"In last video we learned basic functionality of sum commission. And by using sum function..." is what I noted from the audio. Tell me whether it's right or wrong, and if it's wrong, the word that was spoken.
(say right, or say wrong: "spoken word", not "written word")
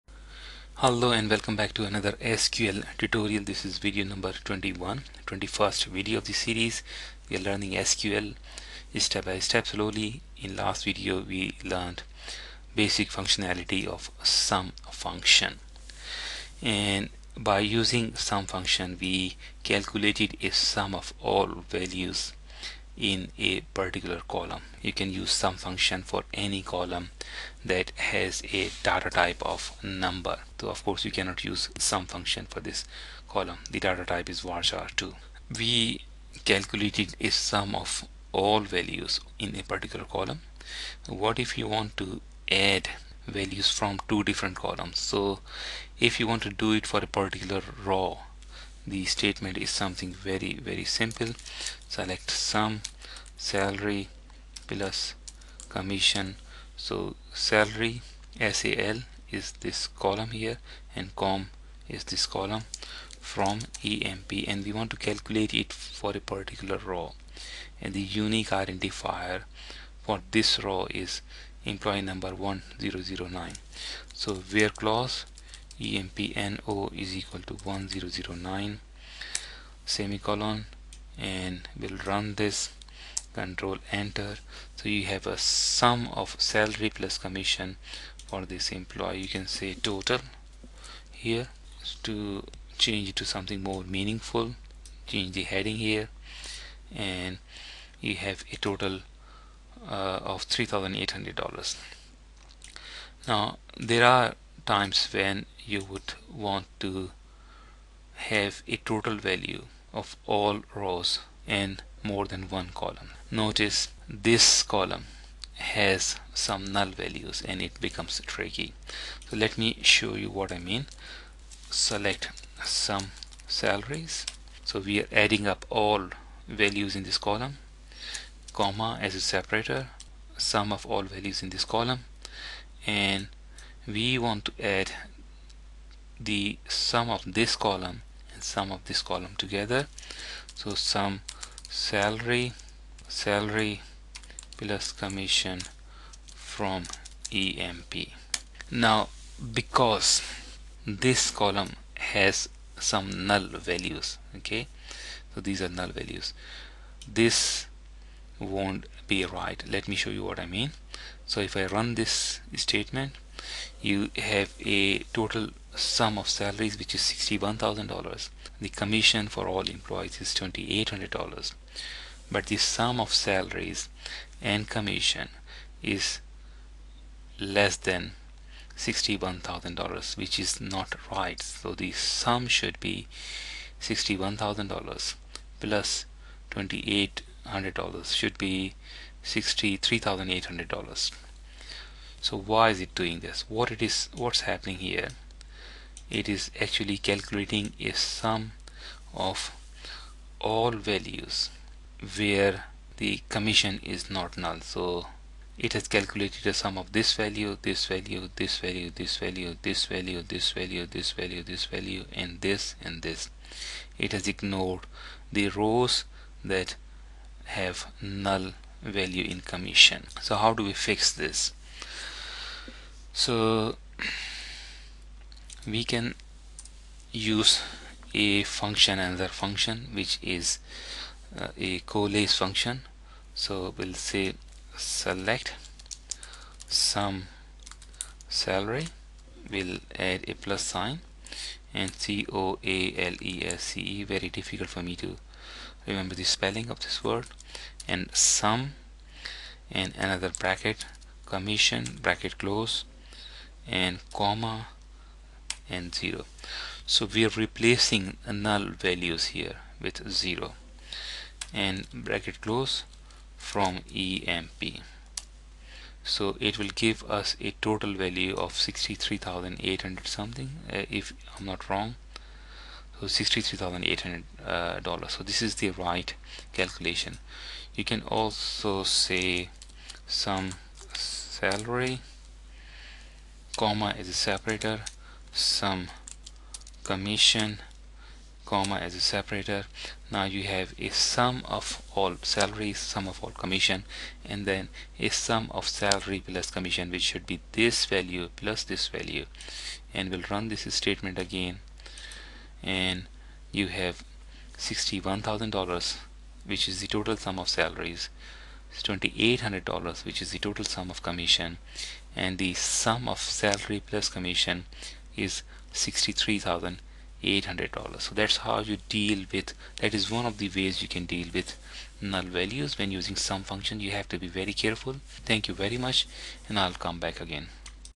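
wrong: "function", not "commission".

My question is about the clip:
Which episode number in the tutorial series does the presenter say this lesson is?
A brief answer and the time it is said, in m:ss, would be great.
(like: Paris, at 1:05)
21, at 0:03.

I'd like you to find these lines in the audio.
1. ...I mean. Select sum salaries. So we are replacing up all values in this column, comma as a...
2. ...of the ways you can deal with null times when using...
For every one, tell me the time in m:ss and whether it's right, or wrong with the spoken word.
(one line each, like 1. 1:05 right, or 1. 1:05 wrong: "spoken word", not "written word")
1. 2:00 wrong: "adding", not "replacing"
2. 5:20 wrong: "values", not "times".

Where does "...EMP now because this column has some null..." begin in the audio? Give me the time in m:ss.
2:27.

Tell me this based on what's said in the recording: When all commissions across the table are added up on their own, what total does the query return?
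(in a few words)
$2,800.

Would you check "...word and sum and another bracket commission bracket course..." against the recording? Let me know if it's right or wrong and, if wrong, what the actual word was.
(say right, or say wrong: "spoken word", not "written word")
wrong: "close", not "course".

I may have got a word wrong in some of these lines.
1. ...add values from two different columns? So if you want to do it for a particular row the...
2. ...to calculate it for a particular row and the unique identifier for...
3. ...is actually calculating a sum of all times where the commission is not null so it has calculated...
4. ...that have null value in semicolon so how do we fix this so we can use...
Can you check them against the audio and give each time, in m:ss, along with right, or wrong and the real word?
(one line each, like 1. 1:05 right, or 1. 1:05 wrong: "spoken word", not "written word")
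1. 0:42 right
2. 1:04 right
3. 3:16 wrong: "values", not "times"
4. 3:36 wrong: "commission", not "semicolon".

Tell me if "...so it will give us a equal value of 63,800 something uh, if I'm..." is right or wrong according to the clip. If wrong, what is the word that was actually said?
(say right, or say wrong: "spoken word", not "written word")
wrong: "total", not "equal".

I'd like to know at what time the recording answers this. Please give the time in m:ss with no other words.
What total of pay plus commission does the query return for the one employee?
1:40.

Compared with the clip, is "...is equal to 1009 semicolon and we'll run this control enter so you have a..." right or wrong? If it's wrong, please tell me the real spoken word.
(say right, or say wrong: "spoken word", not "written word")
right.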